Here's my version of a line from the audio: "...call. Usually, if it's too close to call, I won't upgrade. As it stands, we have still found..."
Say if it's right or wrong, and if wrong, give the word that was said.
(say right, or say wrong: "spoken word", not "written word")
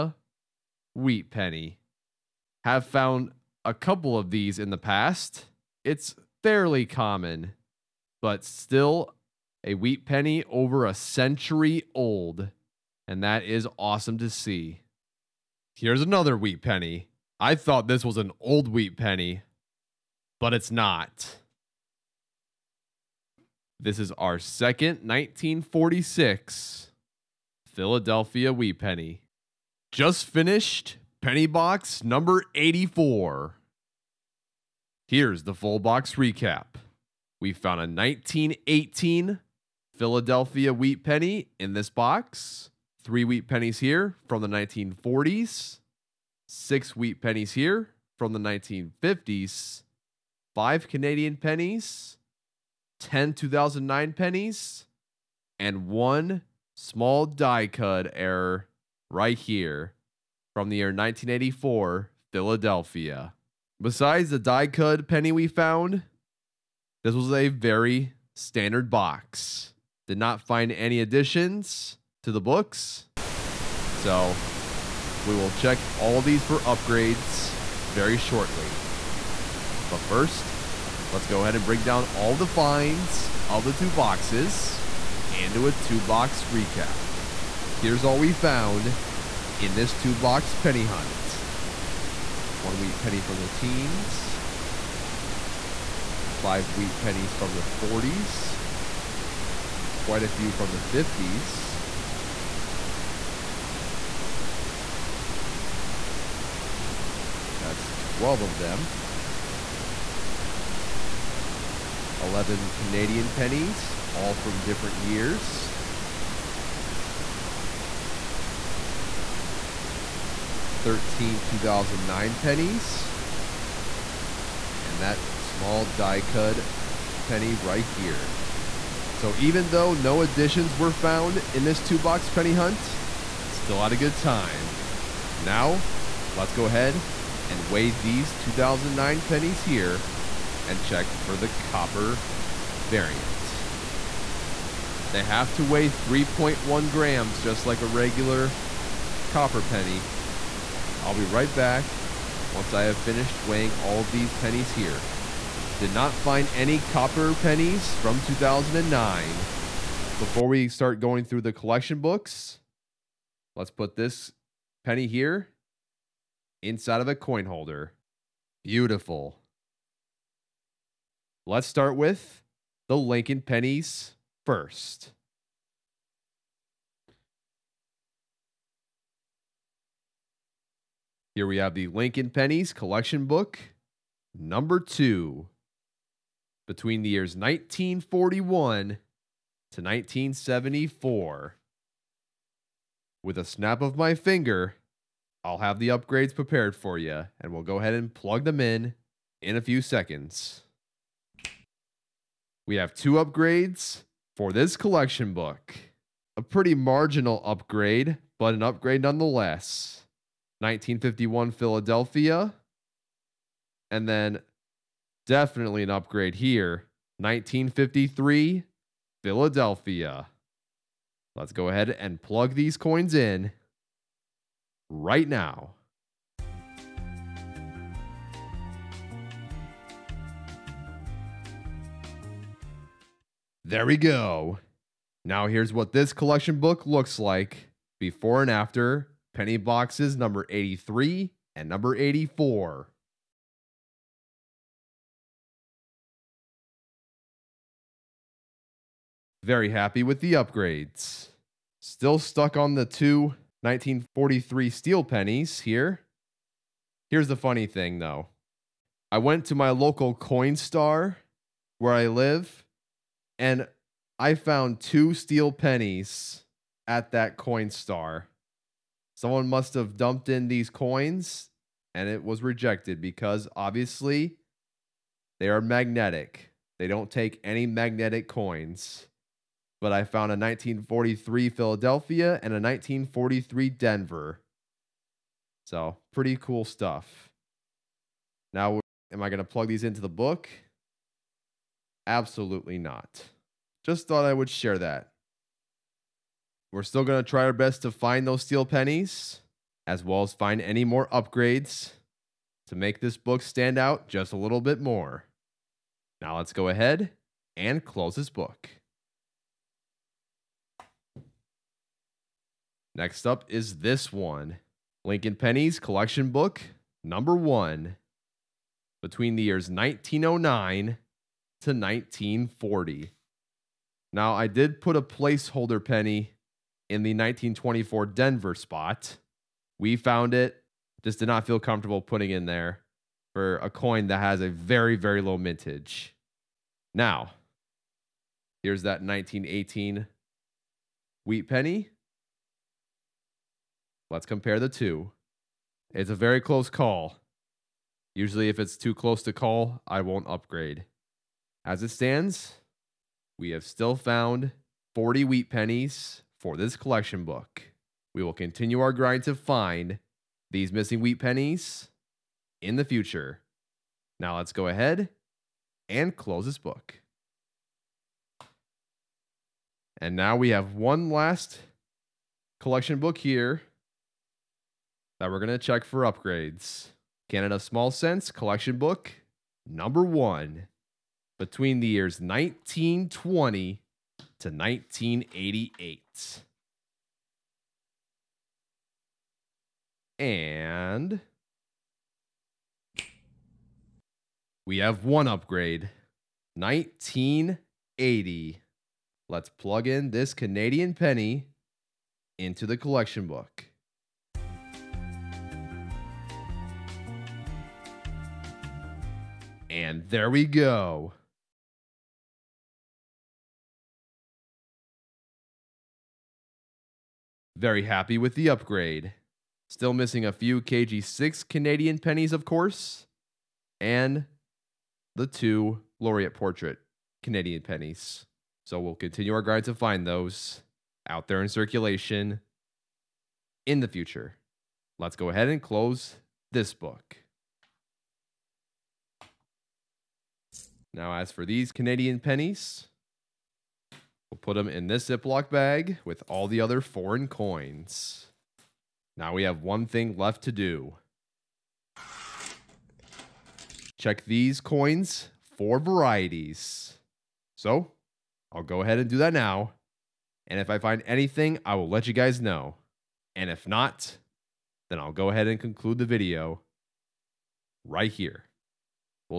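right.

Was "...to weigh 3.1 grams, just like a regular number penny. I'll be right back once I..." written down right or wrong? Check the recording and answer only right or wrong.
wrong.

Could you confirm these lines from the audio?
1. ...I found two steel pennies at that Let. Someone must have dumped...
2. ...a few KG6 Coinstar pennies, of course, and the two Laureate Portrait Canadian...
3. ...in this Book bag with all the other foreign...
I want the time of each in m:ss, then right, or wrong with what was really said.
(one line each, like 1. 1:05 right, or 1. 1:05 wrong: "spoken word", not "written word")
1. 4:24 wrong: "Coinstar", not "Let"
2. 7:00 wrong: "Canadian", not "Coinstar"
3. 7:24 wrong: "Ziploc", not "Book".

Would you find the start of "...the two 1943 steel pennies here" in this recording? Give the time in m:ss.
4:12.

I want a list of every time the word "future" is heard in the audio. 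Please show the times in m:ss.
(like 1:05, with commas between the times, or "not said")
6:02, 7:13.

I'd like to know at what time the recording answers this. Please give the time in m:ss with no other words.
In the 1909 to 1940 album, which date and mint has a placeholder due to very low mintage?
5:27.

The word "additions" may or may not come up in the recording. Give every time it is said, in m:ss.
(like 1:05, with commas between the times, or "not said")
1:10, 2:10.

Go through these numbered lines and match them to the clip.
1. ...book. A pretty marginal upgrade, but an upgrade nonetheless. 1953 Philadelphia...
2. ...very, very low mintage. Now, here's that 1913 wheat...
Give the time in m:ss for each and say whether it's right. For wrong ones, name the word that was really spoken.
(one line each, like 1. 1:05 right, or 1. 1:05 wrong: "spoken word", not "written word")
1. 3:25 wrong: "1951", not "1953"
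2. 5:34 wrong: "1918", not "1913".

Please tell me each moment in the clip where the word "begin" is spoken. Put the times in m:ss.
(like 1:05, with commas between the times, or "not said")
not said.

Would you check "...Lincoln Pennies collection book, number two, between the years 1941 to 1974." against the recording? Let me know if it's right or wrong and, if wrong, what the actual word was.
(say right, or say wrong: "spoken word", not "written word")
right.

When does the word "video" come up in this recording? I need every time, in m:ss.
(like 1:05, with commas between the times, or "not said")
7:46.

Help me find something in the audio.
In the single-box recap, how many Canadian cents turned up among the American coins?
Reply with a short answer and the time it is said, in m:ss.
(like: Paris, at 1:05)
5, at 0:50.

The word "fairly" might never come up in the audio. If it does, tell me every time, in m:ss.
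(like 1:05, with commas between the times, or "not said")
0:06.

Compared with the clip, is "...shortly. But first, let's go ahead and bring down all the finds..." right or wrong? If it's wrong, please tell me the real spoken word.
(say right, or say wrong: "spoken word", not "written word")
right.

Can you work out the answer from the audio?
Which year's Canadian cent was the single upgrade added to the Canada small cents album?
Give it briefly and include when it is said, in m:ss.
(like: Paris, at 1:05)
1980, at 6:36.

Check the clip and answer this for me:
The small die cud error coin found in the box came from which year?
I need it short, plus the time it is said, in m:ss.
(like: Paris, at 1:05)
1984, at 1:00.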